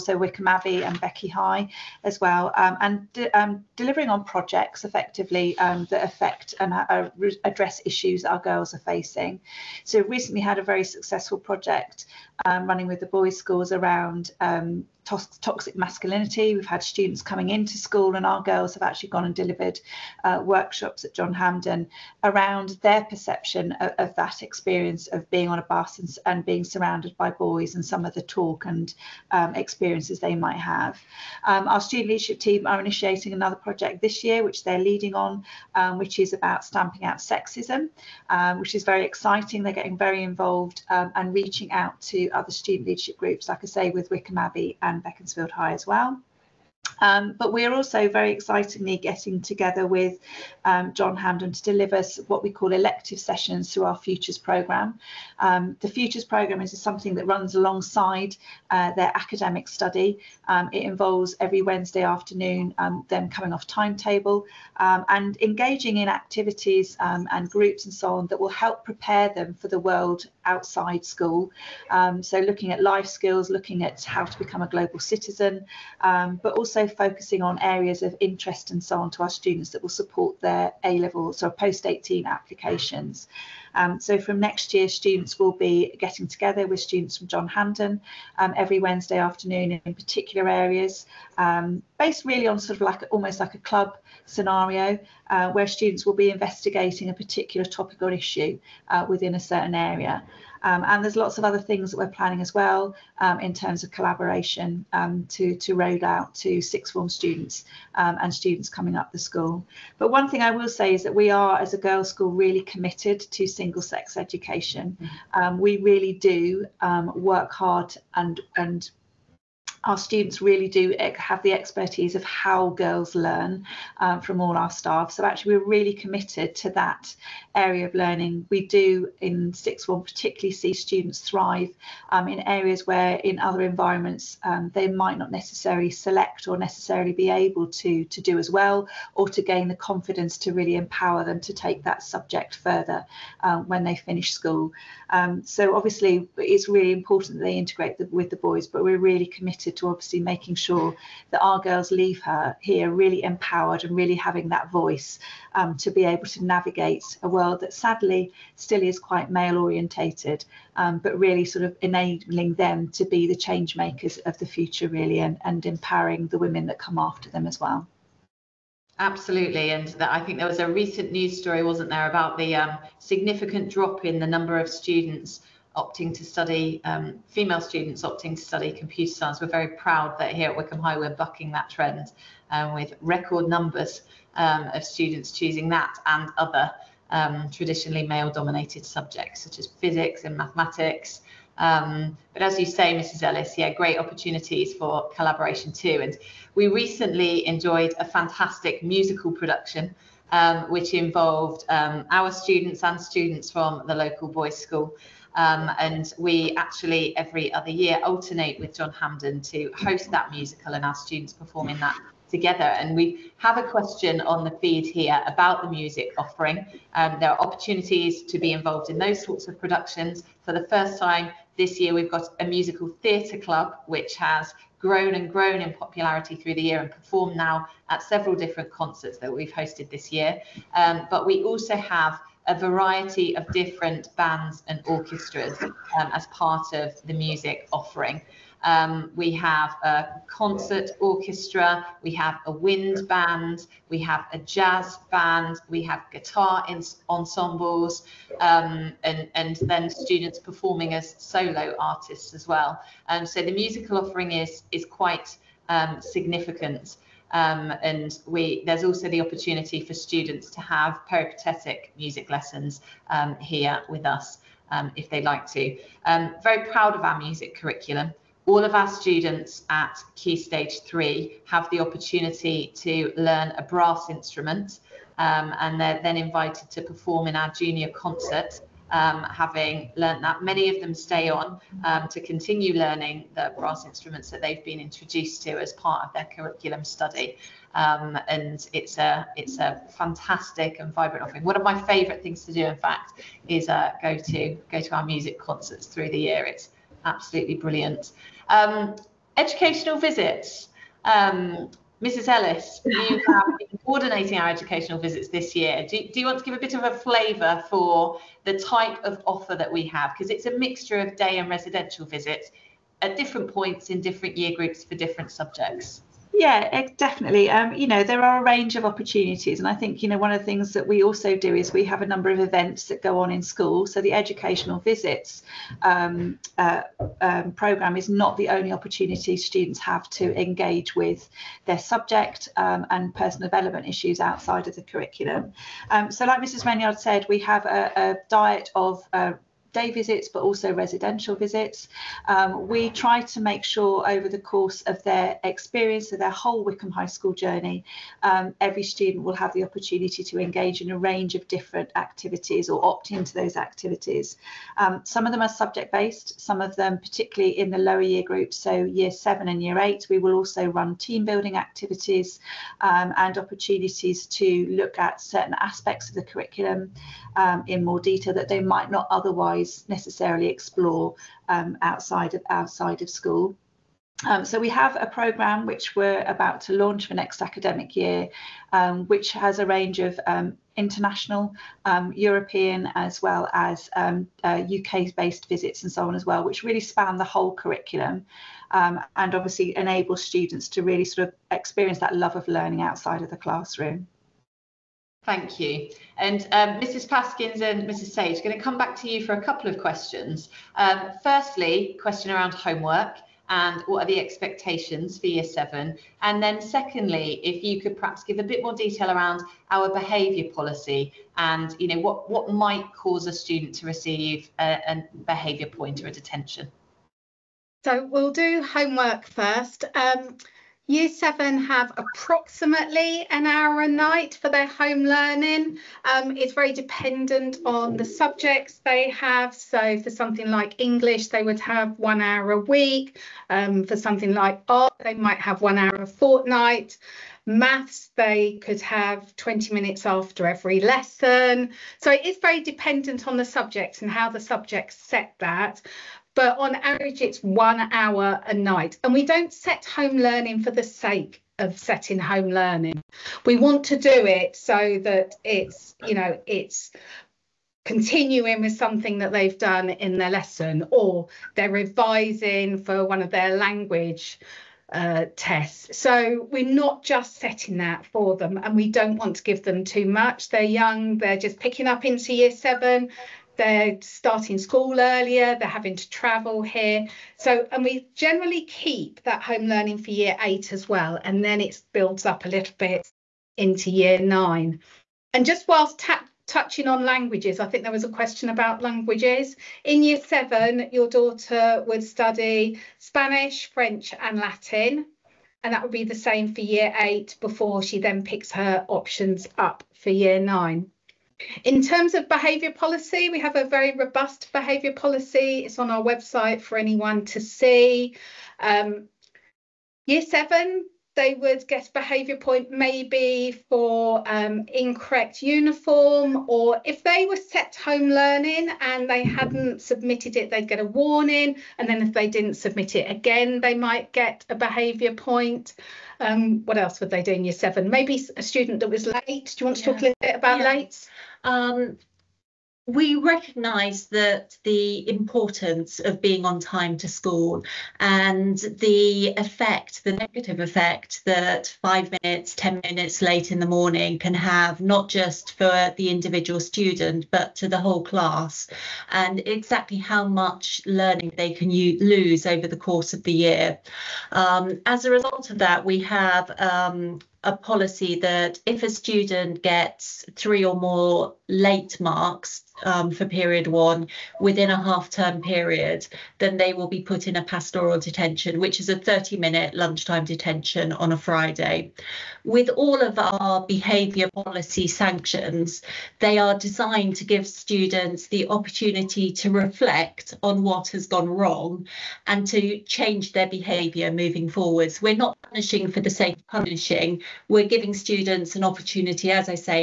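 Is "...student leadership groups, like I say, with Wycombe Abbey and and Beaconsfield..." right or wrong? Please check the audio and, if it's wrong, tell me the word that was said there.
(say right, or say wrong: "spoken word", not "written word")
right.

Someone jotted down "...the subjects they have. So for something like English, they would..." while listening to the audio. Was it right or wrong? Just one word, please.
right.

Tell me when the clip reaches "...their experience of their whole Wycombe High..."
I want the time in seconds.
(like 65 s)
345 s.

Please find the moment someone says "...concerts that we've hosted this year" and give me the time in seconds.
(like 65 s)
228 s.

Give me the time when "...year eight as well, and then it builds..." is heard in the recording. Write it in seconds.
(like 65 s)
480 s.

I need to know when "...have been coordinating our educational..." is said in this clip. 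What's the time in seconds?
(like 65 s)
303 s.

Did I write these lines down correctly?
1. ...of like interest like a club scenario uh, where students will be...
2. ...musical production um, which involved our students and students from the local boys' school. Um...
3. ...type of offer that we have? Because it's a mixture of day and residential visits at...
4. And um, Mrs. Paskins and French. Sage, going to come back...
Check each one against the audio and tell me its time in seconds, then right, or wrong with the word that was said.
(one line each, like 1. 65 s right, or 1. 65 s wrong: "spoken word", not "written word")
1. 92 s wrong: "almost", not "interest"
2. 198 s right
3. 308 s right
4. 396 s wrong: "Mrs", not "French".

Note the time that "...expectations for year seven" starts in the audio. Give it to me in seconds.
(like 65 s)
404 s.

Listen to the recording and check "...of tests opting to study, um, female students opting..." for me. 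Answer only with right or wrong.
wrong.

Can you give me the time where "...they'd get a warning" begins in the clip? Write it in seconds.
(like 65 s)
520 s.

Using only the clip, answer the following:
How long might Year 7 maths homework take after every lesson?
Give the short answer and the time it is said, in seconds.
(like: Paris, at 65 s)
20 minutes, at 439 s.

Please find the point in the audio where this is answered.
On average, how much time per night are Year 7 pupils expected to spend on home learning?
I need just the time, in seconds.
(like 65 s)
423 s.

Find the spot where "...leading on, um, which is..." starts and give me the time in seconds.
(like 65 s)
34 s.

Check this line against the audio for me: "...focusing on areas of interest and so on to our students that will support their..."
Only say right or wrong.
right.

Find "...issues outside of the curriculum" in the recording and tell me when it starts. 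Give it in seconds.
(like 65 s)
333 s.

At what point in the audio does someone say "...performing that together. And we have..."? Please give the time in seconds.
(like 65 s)
211 s.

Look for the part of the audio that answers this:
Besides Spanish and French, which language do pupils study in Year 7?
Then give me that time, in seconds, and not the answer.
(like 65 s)
494 s.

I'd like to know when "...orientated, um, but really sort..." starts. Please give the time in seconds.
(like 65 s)
159 s.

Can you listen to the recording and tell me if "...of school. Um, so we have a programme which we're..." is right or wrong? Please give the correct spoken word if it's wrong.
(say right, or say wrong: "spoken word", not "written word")
right.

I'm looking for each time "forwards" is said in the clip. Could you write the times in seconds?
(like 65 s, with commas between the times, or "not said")
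584 s.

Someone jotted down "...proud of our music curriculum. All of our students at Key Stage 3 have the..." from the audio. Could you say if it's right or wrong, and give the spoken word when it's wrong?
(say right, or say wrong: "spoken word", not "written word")
right.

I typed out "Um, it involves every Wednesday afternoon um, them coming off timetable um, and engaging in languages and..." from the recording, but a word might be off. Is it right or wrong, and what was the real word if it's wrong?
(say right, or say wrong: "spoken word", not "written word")
wrong: "activities", not "languages".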